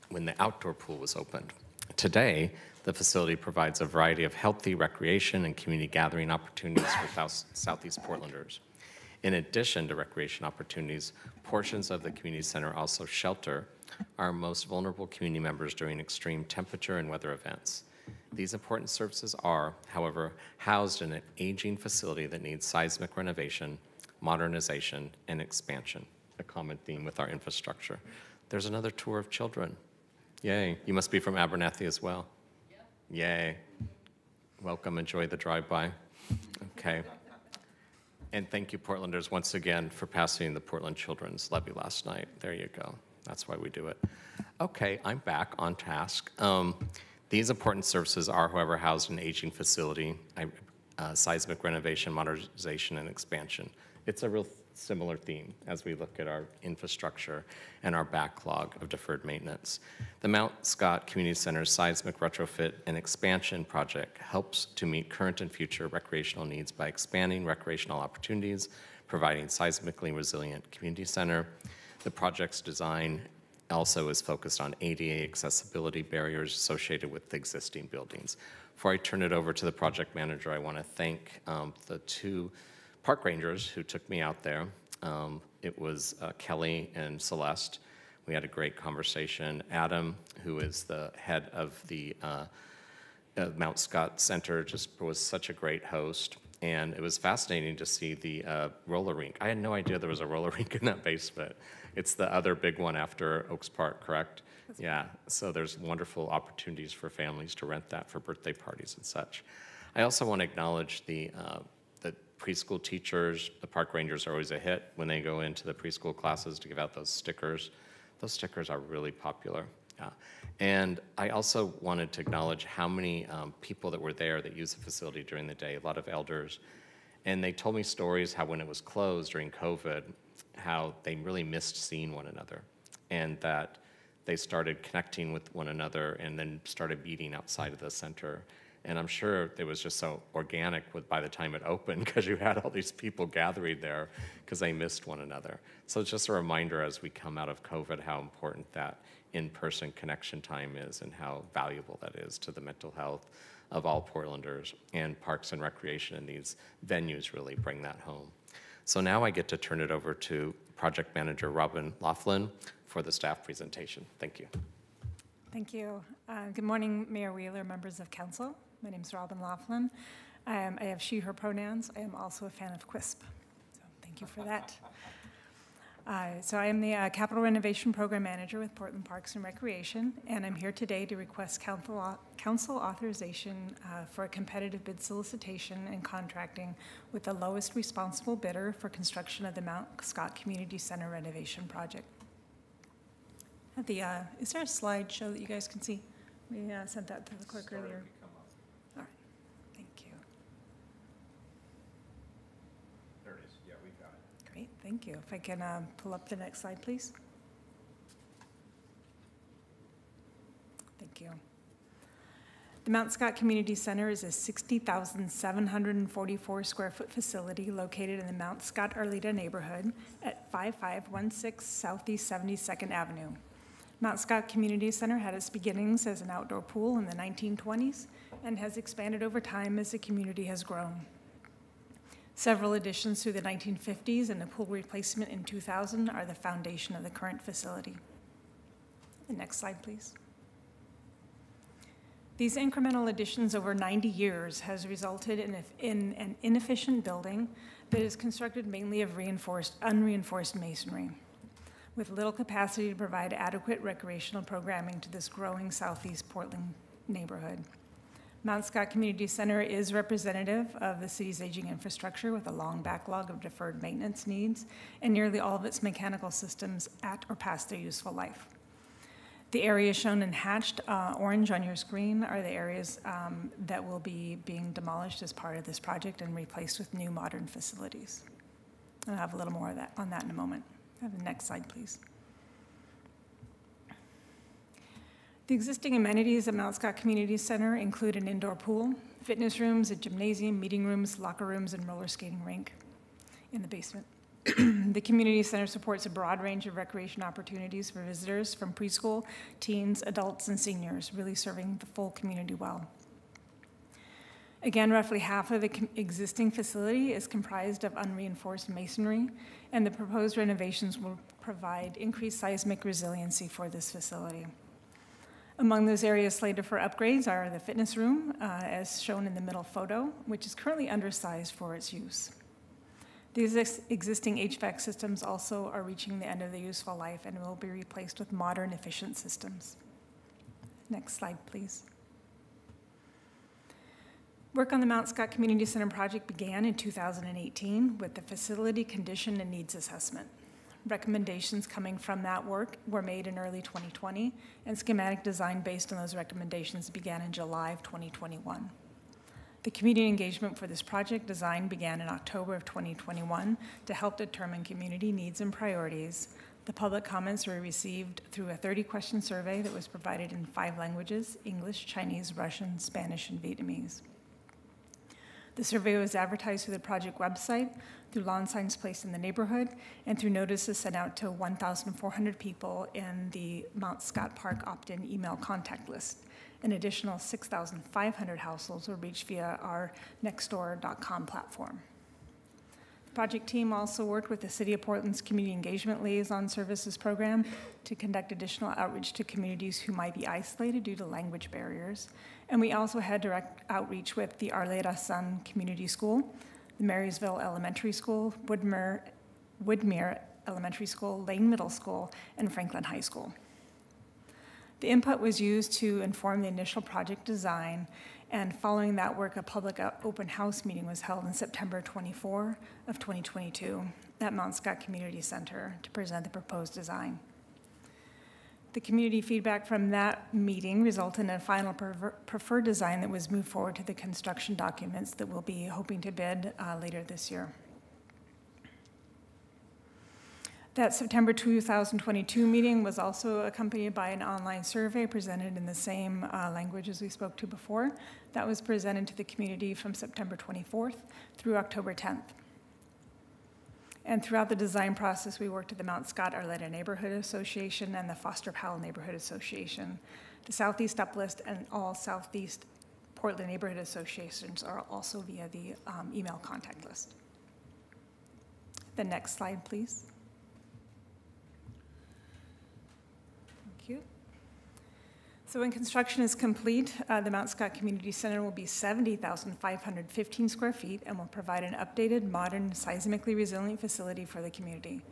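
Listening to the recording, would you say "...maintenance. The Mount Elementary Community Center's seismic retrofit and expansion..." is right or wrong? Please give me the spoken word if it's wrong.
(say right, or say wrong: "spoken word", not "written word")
wrong: "Scott", not "Elementary".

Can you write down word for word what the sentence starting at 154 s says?
And Parks and Recreation and these venues really bring that home.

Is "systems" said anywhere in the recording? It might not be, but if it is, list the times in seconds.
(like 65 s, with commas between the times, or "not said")
266 s, 324 s, 329 s.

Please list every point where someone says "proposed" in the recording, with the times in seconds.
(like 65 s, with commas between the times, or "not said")
309 s, 416 s.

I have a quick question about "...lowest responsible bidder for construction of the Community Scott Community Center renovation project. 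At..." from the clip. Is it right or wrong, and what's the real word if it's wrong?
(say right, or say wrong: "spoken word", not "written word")
wrong: "Mount", not "Community".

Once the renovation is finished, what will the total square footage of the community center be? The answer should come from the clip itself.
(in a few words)
70,515.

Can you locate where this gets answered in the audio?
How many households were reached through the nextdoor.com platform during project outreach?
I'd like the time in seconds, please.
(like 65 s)
377 s.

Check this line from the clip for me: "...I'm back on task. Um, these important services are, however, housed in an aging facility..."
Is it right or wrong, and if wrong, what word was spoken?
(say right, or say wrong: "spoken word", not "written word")
right.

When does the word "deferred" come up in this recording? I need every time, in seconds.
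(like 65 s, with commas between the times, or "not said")
58 s, 263 s.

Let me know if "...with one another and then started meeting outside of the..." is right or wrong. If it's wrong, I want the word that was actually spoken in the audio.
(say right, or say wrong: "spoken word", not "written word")
right.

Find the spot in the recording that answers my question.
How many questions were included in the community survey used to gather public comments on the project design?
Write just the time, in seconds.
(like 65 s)
358 s.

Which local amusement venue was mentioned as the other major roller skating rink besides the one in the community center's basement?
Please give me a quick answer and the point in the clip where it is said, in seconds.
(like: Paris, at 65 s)
Oaks Park, at 103 s.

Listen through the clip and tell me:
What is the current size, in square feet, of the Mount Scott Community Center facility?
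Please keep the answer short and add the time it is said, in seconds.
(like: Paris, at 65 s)
60,744, at 214 s.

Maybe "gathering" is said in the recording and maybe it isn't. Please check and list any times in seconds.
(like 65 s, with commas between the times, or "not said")
5 s, 143 s.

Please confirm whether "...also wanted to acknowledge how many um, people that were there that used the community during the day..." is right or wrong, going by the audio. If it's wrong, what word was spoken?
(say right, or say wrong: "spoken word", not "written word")
wrong: "facility", not "community".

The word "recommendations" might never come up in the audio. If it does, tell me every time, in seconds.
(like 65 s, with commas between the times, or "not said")
340 s, 346 s.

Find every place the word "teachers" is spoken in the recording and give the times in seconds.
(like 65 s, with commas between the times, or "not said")
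112 s.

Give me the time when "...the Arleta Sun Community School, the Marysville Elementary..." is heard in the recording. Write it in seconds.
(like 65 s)
394 s.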